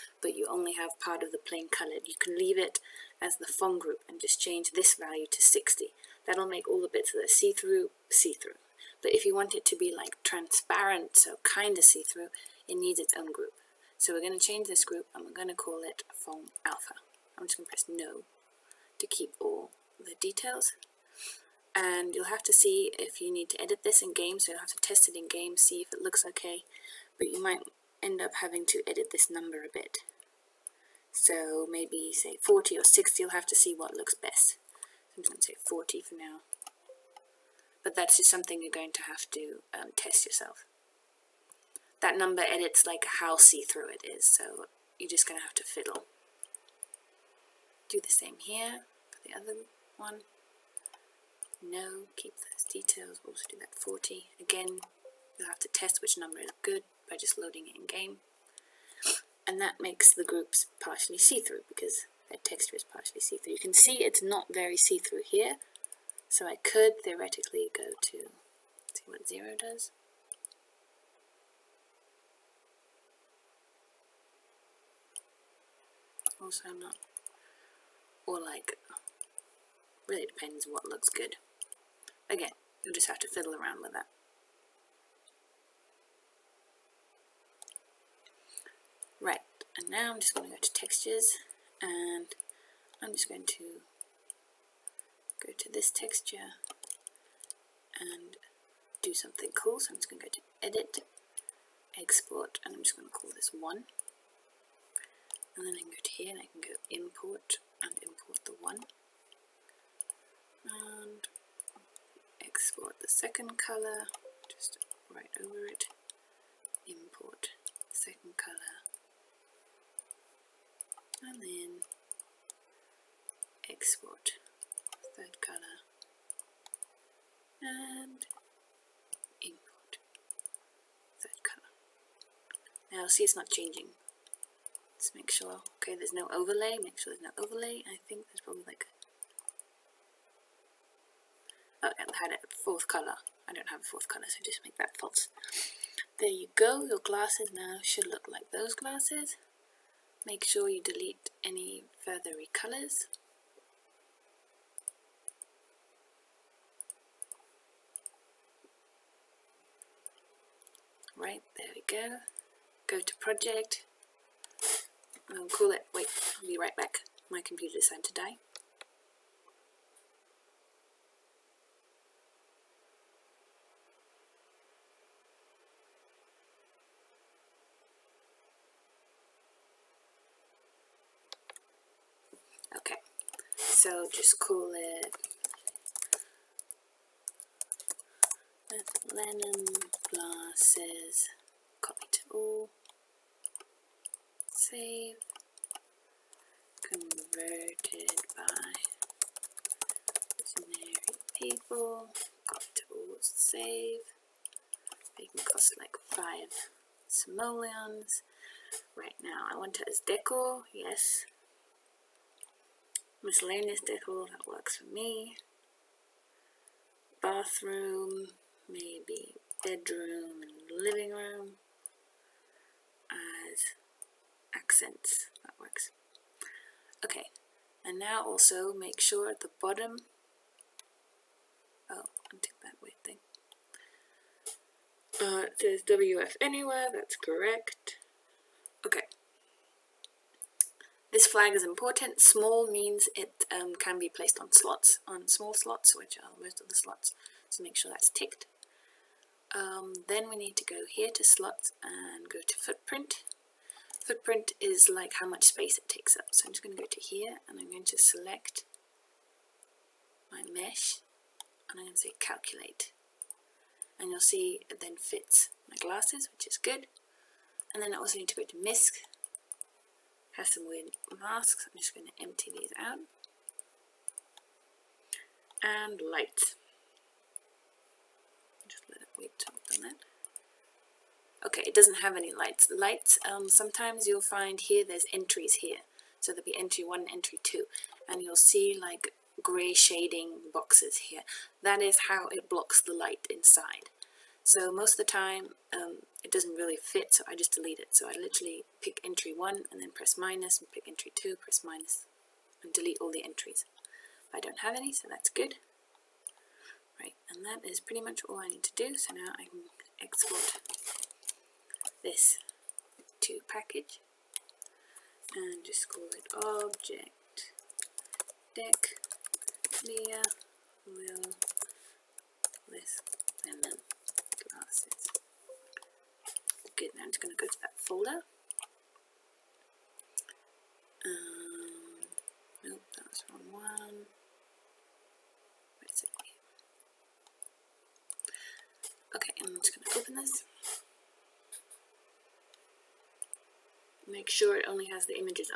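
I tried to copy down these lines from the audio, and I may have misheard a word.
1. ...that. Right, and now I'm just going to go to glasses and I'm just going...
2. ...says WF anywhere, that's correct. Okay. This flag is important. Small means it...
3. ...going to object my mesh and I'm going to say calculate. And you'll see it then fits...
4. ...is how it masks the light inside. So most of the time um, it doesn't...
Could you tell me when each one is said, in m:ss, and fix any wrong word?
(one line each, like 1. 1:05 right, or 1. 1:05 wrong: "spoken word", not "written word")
1. 1:23 wrong: "textures", not "glasses"
2. 3:55 right
3. 4:17 wrong: "select", not "object"
4. 4:51 wrong: "blocks", not "masks".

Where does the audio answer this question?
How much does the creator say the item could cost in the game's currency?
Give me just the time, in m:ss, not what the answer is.
3:26.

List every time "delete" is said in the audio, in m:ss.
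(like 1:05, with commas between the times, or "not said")
2:30, 4:57, 5:02.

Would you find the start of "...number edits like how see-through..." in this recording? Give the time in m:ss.
0:42.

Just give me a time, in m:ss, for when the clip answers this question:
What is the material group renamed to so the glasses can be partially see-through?
0:16.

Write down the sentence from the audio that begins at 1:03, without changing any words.
You can see it's not very see-through here, so I could theoretically zero does.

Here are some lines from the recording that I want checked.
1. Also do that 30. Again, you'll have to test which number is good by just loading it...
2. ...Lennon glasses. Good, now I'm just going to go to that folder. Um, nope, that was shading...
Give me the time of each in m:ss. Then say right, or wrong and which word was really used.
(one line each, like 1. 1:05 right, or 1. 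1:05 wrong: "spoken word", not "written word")
1. 0:53 wrong: "40", not "30"
2. 5:23 wrong: "wrong", not "shading".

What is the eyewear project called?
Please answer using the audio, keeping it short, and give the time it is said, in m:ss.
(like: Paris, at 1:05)
Lennon glasses, at 3:09.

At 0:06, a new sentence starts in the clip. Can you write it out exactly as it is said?
That'll make all the bits that are see-through, see-through.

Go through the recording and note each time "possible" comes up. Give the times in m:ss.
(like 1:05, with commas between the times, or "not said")
not said.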